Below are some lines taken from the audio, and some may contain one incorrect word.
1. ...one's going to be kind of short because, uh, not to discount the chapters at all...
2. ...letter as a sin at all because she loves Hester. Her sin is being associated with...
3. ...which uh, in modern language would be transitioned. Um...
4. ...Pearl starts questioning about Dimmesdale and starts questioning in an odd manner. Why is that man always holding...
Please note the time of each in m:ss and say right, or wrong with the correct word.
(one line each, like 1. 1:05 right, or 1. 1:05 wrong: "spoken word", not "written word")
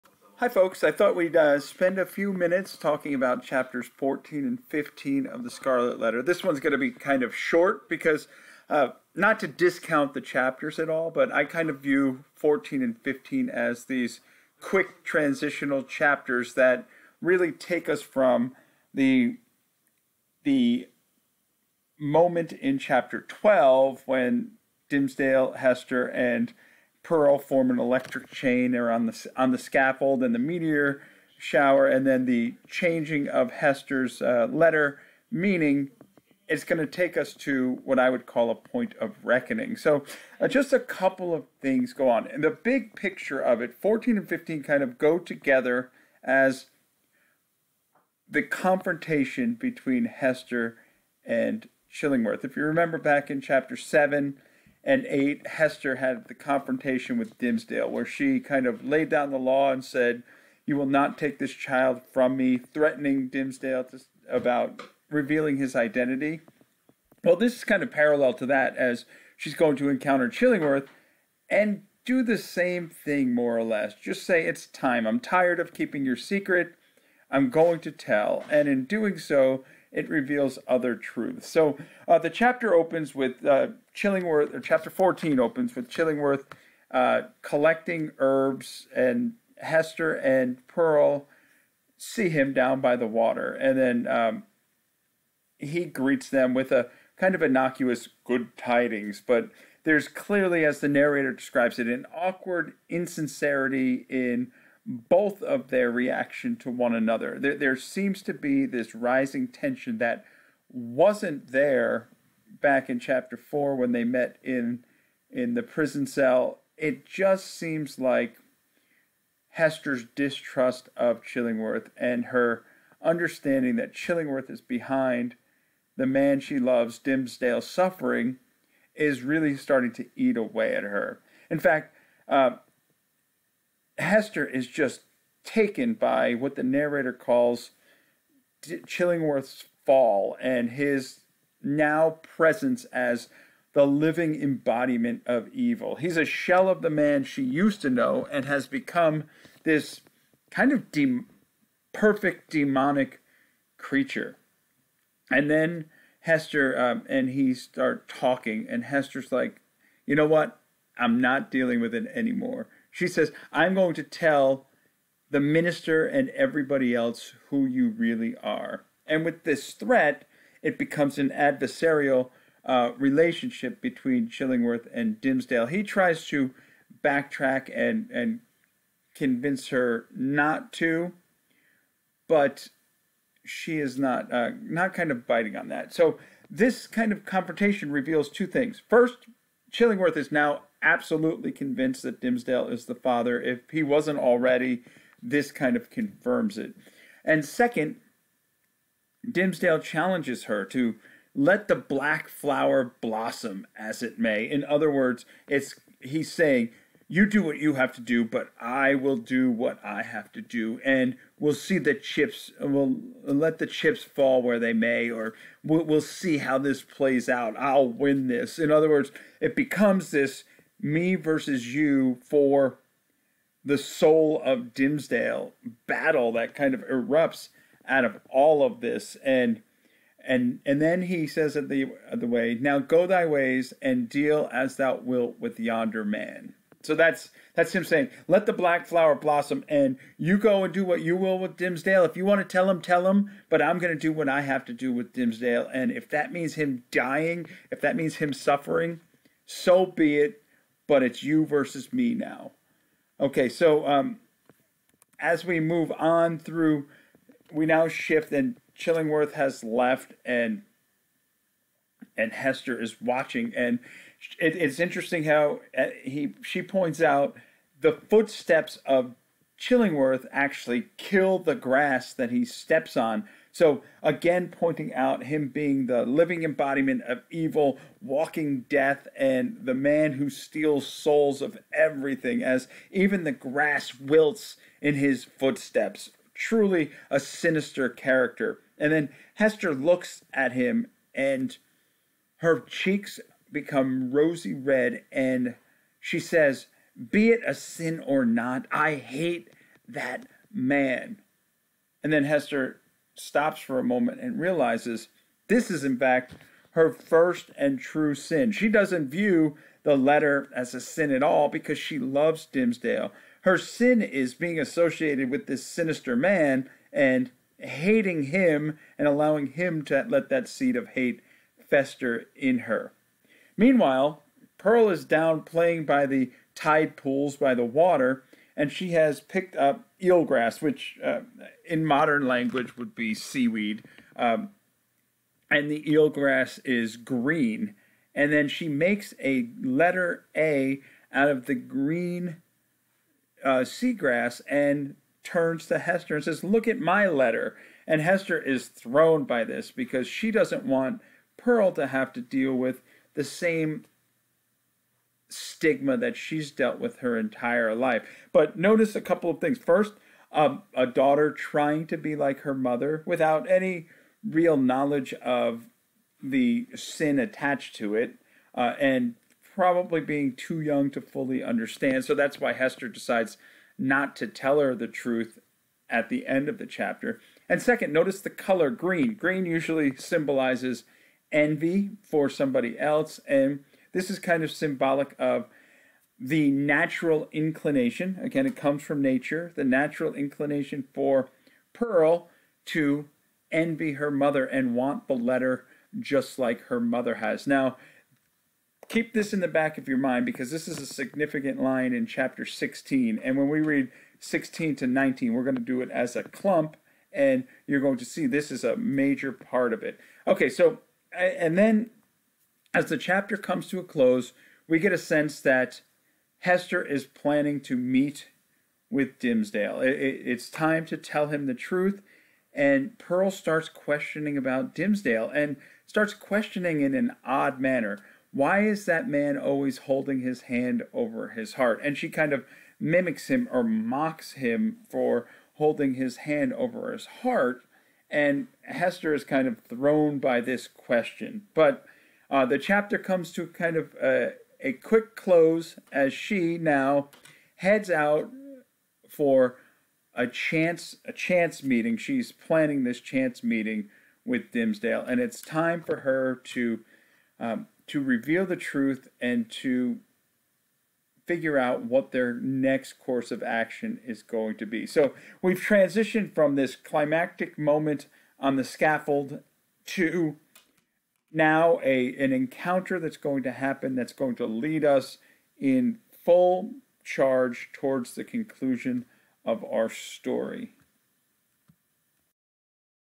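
1. 0:06 right
2. 5:09 wrong: "Dimmesdale", not "Hester"
3. 5:30 wrong: "seaweed", not "transitioned"
4. 7:02 right.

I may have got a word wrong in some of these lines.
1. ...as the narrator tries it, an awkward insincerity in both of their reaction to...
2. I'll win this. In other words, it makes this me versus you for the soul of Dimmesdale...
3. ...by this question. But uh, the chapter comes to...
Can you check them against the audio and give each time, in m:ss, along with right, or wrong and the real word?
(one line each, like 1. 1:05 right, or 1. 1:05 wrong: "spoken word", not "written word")
1. 1:40 wrong: "describes", not "tries"
2. 3:37 wrong: "becomes", not "makes"
3. 7:20 right.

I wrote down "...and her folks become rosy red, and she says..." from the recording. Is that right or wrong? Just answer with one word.
wrong.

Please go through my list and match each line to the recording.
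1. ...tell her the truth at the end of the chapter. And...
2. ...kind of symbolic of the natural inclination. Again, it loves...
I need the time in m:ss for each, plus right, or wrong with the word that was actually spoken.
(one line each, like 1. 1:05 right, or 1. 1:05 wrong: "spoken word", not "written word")
1. 6:14 right
2. 6:24 wrong: "comes", not "loves".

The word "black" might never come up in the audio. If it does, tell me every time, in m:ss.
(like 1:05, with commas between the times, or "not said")
3:21, 3:58.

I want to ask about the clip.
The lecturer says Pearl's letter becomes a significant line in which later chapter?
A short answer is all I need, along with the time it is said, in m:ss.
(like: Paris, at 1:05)
16, at 6:42.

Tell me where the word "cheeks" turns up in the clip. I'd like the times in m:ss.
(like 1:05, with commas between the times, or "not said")
4:52.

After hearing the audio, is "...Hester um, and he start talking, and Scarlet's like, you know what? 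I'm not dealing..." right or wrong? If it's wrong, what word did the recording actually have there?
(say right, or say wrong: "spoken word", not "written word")
wrong: "Hester", not "Scarlet".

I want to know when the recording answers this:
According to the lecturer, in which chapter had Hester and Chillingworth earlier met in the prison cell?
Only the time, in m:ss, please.
1:52.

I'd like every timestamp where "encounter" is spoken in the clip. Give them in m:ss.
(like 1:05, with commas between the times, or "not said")
1:09, 7:52.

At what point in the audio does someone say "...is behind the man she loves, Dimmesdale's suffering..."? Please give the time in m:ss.
2:04.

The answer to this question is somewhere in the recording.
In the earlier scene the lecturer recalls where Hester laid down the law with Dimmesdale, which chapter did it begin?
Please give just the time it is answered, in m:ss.
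0:53.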